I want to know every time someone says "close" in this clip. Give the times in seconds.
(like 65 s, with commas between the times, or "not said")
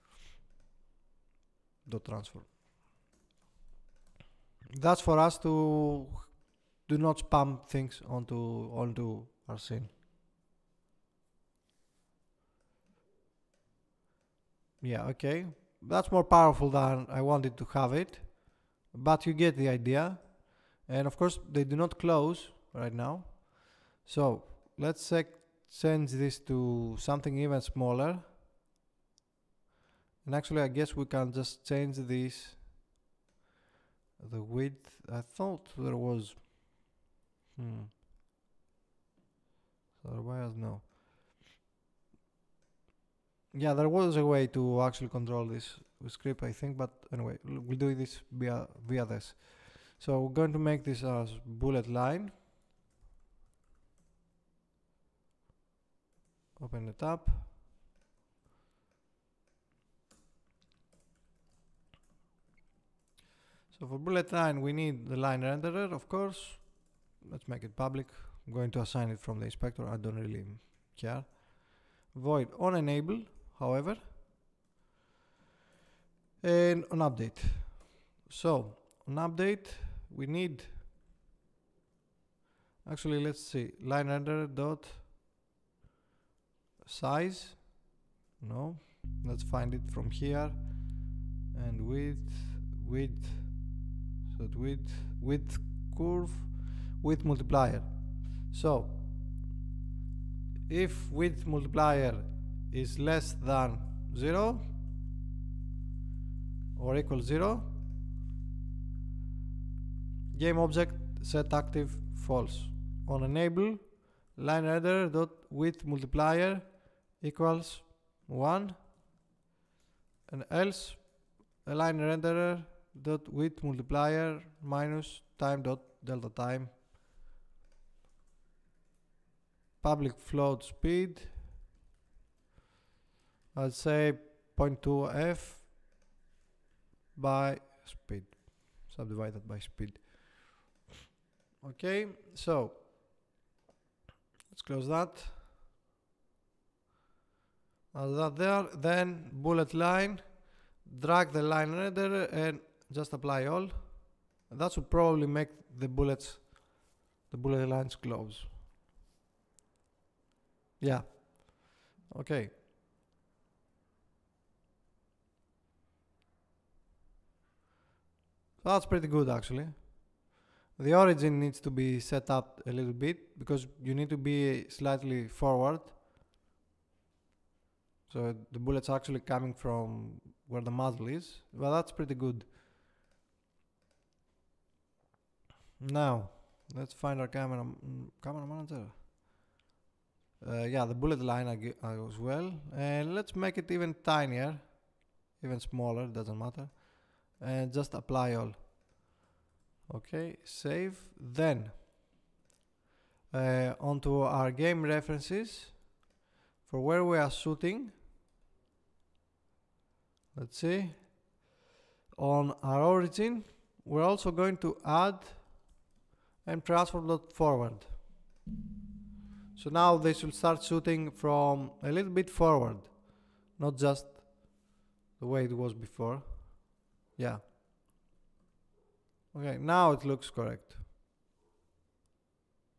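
21 s, 144 s, 157 s.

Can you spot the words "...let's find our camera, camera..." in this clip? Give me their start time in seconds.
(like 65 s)
186 s.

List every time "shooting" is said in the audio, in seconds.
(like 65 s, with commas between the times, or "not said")
207 s, 220 s.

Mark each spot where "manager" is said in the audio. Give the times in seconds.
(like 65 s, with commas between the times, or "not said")
188 s.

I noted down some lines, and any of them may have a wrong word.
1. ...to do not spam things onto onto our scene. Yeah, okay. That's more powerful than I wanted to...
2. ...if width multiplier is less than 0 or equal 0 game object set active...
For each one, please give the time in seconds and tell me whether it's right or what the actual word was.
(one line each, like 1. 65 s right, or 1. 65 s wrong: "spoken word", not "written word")
1. 5 s right
2. 100 s right.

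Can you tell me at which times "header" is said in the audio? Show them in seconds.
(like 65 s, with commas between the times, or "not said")
114 s.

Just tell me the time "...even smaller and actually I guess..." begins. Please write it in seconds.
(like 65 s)
27 s.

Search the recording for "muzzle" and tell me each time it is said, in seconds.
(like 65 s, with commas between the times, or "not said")
180 s.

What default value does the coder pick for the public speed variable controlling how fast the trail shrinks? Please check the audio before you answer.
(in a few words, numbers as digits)
0.2.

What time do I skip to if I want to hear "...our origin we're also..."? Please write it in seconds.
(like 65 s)
212 s.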